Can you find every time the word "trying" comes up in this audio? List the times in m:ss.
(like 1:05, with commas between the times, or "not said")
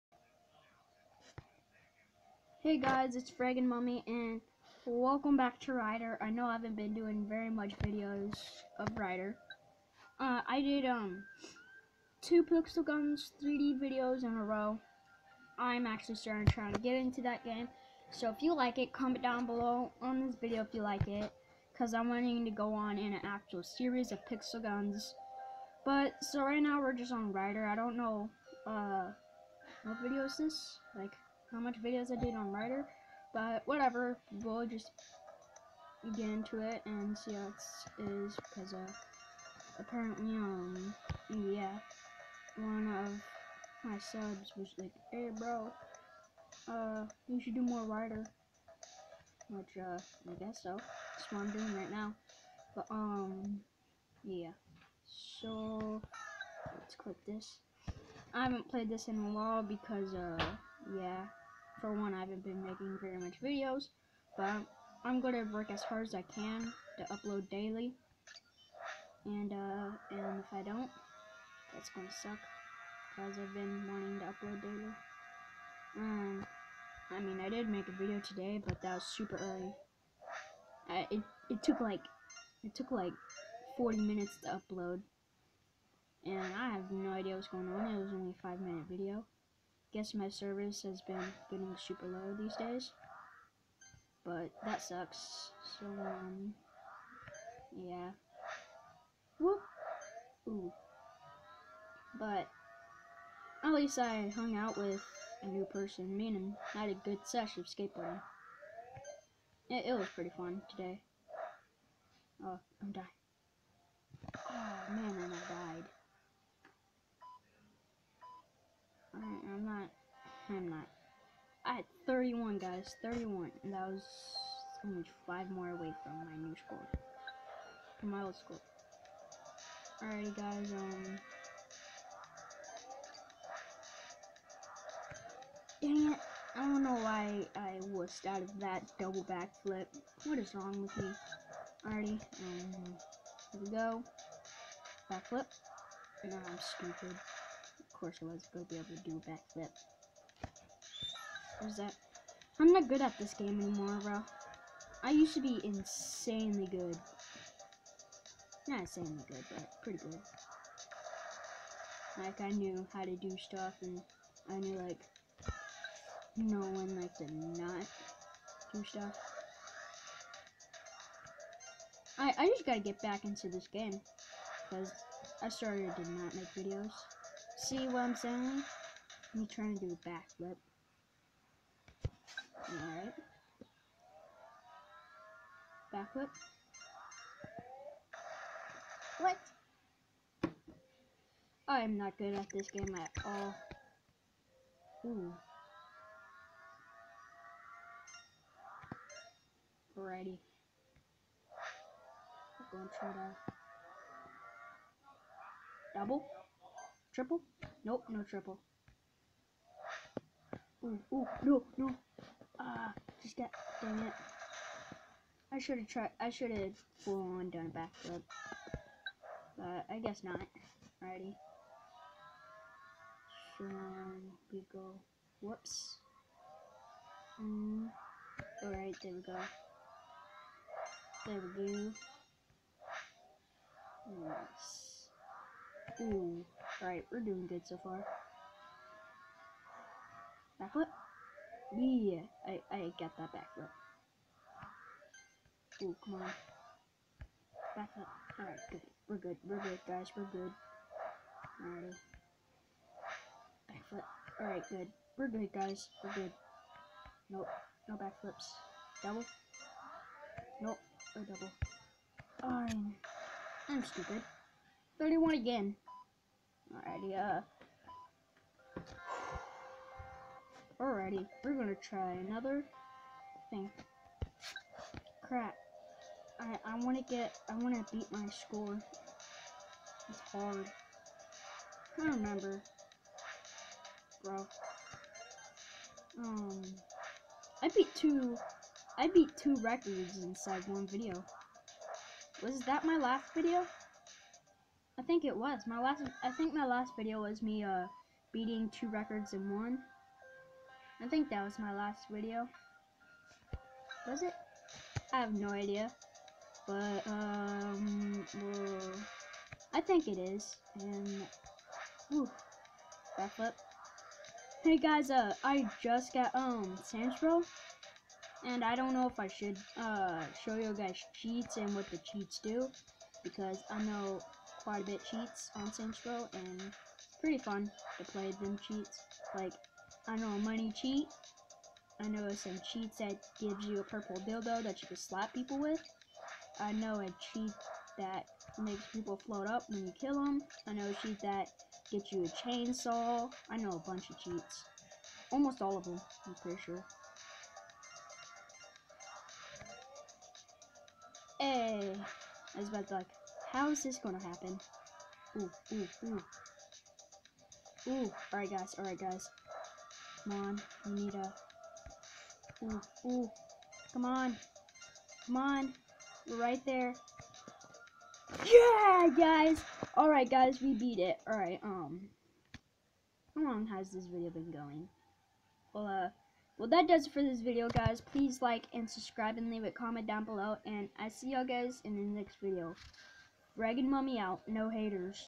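2:59.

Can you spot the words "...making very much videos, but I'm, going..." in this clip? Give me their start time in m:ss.
1:02.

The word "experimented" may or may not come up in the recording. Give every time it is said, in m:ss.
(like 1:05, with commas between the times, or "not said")
not said.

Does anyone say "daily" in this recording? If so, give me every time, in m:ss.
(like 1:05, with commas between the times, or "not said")
1:07, 1:14.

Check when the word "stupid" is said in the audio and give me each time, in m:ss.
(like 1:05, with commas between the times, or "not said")
2:26, 4:23.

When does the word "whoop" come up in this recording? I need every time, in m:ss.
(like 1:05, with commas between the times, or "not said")
1:39, 3:45.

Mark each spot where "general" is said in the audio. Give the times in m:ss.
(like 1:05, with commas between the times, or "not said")
not said.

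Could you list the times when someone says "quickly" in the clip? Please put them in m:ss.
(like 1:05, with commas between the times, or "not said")
not said.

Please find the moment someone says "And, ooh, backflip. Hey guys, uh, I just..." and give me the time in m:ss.
5:10.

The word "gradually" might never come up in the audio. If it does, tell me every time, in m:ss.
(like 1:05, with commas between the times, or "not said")
not said.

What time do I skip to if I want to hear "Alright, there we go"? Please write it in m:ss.
3:48.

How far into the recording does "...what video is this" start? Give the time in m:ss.
0:29.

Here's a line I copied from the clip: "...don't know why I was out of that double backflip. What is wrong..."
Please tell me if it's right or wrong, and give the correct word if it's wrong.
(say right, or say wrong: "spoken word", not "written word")
right.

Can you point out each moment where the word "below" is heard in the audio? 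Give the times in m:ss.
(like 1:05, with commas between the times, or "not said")
0:19, 6:20.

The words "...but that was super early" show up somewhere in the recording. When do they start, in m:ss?
1:18.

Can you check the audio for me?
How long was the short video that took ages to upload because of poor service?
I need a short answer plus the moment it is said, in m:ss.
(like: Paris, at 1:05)
5 minutes, at 1:28.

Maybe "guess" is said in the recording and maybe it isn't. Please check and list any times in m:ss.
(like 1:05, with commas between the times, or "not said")
0:50, 1:29, 3:39.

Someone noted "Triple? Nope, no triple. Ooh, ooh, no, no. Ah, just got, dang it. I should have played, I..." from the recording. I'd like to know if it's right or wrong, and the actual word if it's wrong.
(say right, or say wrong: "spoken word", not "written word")
wrong: "tried", not "played".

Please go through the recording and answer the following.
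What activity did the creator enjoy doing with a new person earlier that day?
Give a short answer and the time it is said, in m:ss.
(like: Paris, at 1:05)
Skateboarding, at 1:47.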